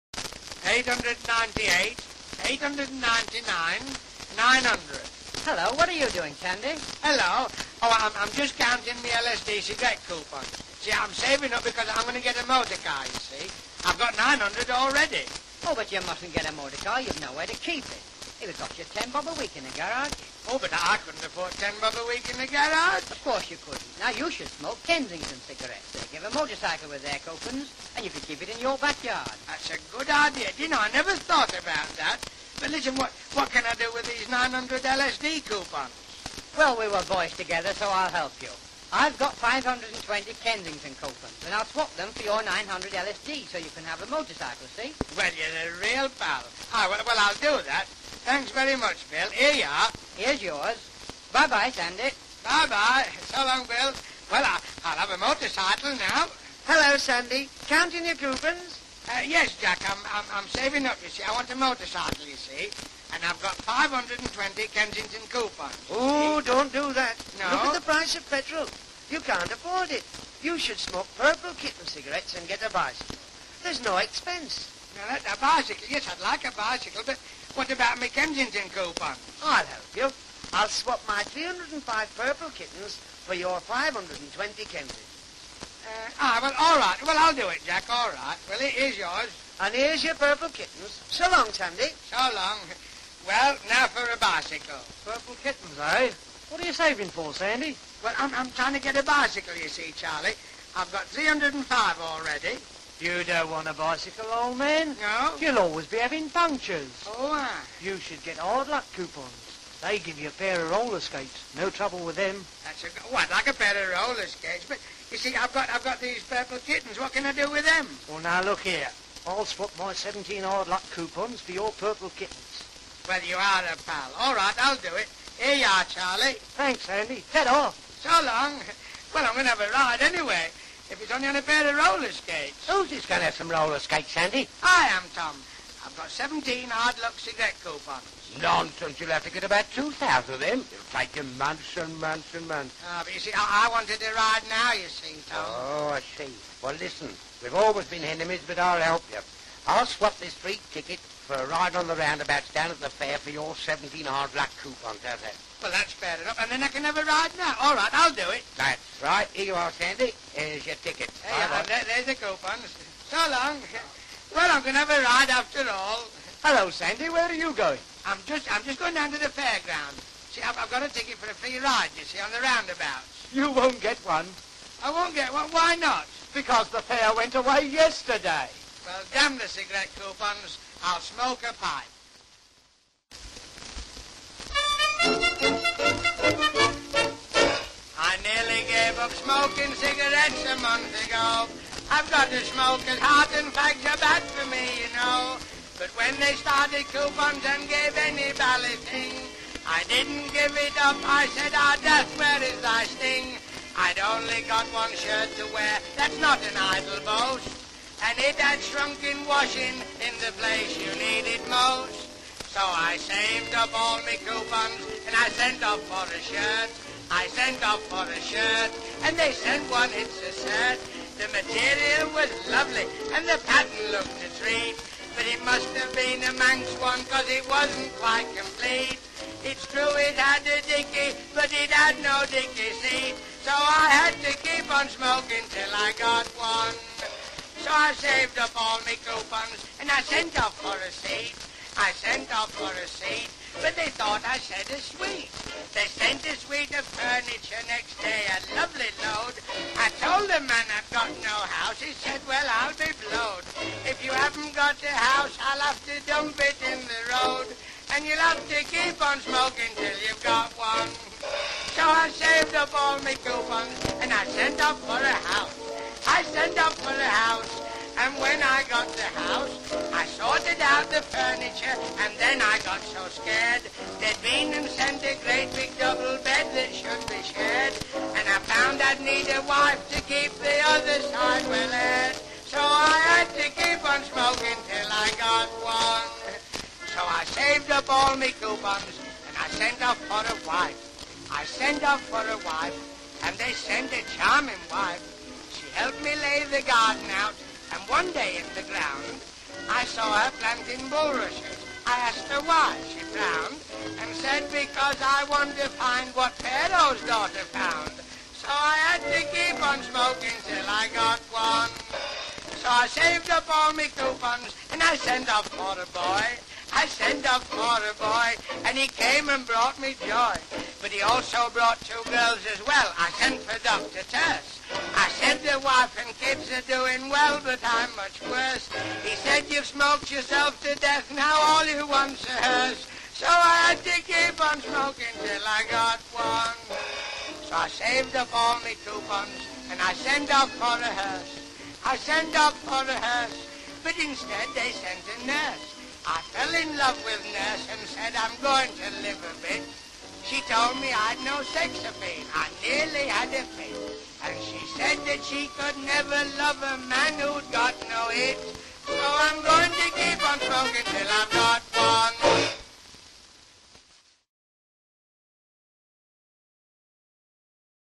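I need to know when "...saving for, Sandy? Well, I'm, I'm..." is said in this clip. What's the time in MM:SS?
01:36.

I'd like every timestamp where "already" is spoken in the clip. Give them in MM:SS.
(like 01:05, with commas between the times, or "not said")
00:14, 01:42.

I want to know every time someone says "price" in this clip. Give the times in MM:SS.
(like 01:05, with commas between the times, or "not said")
01:07.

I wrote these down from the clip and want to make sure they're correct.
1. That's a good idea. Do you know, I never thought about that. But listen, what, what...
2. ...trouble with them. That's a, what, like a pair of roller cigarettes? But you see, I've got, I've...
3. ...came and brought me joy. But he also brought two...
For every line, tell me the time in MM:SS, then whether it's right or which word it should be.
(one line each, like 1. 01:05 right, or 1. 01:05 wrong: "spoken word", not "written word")
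1. 00:29 right
2. 01:51 wrong: "skates", not "cigarettes"
3. 05:18 right.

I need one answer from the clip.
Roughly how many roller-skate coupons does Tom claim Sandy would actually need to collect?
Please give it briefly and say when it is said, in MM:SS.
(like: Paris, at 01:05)
2,000, at 02:19.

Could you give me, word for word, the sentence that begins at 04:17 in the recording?
And you'll have to keep on smoking till you've got one.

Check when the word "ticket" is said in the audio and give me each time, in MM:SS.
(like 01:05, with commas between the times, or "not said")
02:30, 02:40, 02:50.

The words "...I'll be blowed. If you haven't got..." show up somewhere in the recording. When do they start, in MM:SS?
04:12.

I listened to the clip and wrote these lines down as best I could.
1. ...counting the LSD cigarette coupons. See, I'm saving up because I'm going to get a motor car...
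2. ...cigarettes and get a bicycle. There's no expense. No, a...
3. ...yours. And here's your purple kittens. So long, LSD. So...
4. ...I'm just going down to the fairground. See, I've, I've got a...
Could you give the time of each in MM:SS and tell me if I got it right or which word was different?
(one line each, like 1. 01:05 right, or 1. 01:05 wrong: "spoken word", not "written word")
1. 00:08 right
2. 01:11 right
3. 01:28 wrong: "Sandy", not "LSD"
4. 02:48 right.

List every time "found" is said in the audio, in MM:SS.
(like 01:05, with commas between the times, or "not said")
04:38, 05:07.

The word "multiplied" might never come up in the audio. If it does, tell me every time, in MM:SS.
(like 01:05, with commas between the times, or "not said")
not said.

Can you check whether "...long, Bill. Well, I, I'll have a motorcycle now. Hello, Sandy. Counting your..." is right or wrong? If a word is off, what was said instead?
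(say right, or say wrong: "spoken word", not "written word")
right.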